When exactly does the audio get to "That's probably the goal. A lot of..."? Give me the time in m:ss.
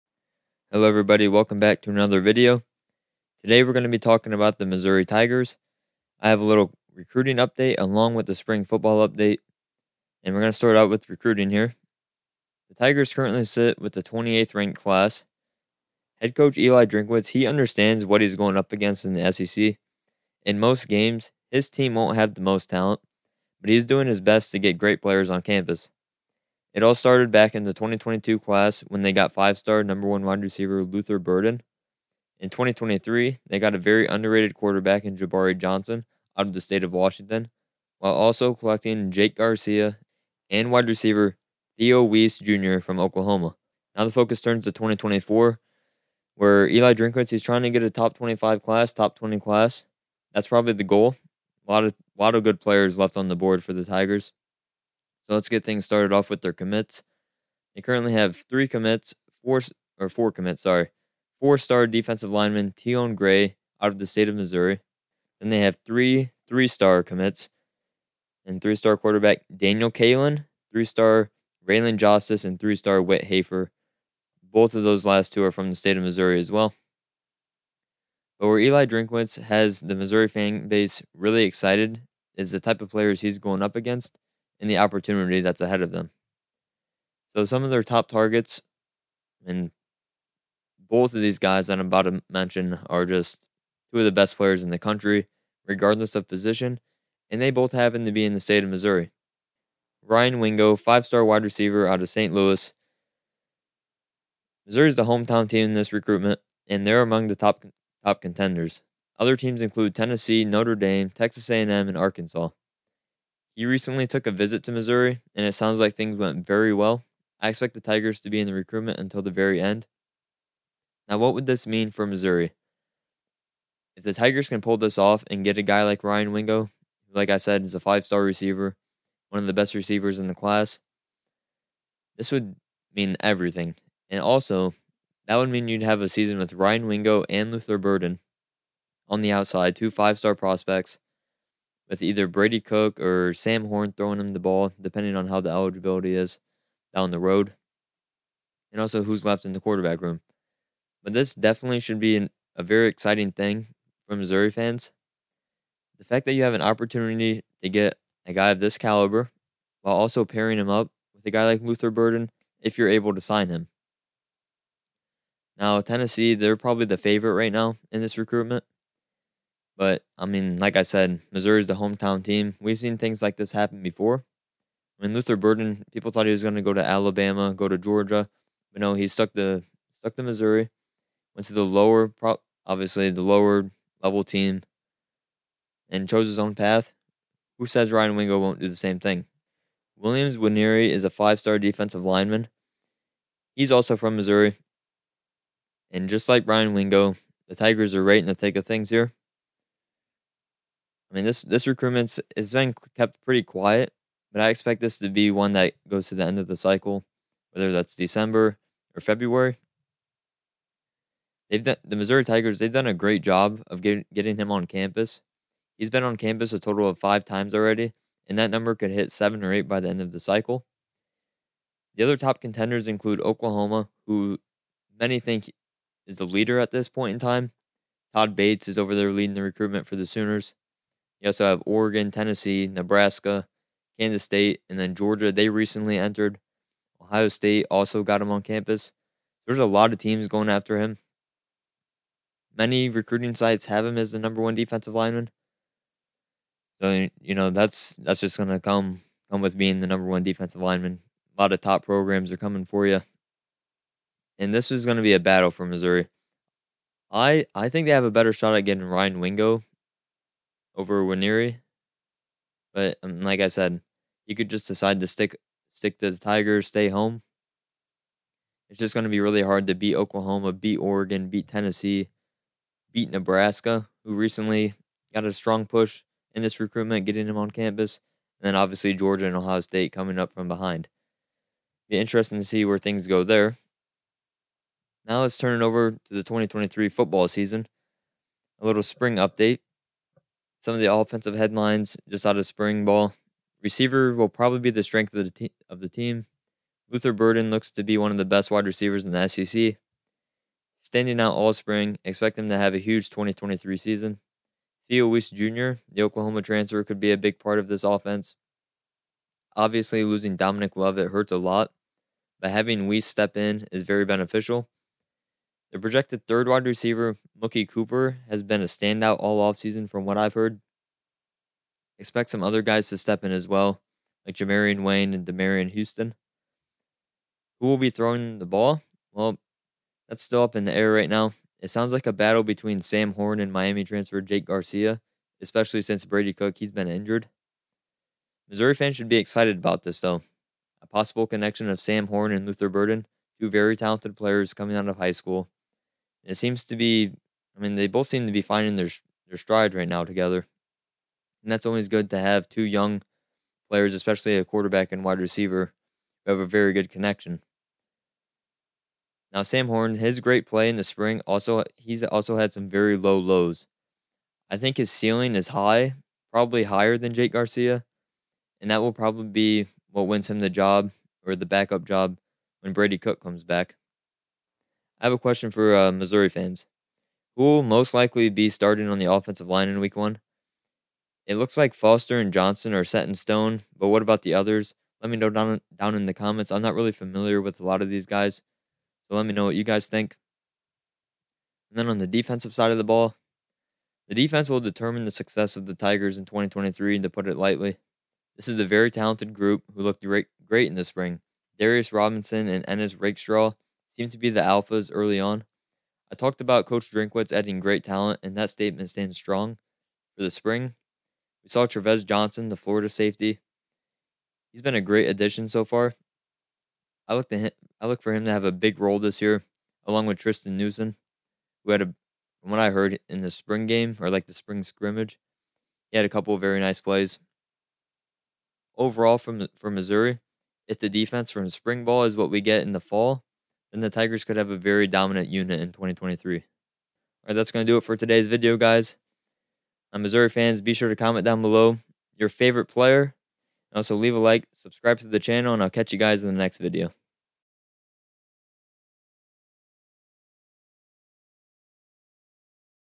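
0:50.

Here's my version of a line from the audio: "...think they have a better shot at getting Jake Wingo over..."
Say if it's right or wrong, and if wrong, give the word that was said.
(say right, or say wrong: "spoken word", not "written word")
wrong: "Ryan", not "Jake".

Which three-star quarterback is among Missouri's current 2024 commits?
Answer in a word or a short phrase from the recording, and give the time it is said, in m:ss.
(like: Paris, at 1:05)
Daniel Kaelin, at 1:09.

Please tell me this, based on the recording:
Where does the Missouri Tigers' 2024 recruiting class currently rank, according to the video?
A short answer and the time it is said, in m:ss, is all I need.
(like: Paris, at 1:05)
28th, at 0:14.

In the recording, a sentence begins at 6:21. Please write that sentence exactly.
It looks like Foster and Johnson are set in stone, but what about the others?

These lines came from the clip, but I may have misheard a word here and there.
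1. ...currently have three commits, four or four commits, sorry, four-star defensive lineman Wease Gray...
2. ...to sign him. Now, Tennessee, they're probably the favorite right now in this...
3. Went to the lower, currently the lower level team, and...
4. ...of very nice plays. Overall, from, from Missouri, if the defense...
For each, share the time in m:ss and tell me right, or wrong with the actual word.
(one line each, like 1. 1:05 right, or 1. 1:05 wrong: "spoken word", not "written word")
1. 0:57 wrong: "Tion", not "Wease"
2. 2:43 right
3. 3:01 wrong: "obviously", not "currently"
4. 7:06 right.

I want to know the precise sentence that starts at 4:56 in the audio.
Luther Burden looks to be one of the best wide receivers in the SEC.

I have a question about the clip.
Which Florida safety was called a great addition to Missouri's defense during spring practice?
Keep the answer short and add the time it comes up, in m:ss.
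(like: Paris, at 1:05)
Trevez Johnson, at 6:51.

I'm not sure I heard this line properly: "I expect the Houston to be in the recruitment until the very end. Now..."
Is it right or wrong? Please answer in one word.
wrong.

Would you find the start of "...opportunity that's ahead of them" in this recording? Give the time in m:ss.
1:24.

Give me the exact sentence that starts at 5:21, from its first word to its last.
Expect some other guys to step in as well, like Jamarian Wayne and Demarion Houston.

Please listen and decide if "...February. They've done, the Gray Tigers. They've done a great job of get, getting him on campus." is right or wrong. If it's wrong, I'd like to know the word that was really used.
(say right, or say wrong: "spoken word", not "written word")
wrong: "Missouri", not "Gray".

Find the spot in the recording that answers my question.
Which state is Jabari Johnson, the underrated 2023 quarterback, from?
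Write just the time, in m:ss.
0:36.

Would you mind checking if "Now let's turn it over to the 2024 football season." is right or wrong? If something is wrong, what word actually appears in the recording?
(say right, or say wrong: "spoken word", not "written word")
wrong: "2023", not "2024".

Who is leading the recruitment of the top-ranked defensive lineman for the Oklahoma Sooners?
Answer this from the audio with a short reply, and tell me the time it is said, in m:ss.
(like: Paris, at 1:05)
Todd Bates, at 3:48.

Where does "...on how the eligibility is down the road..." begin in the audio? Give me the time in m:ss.
2:25.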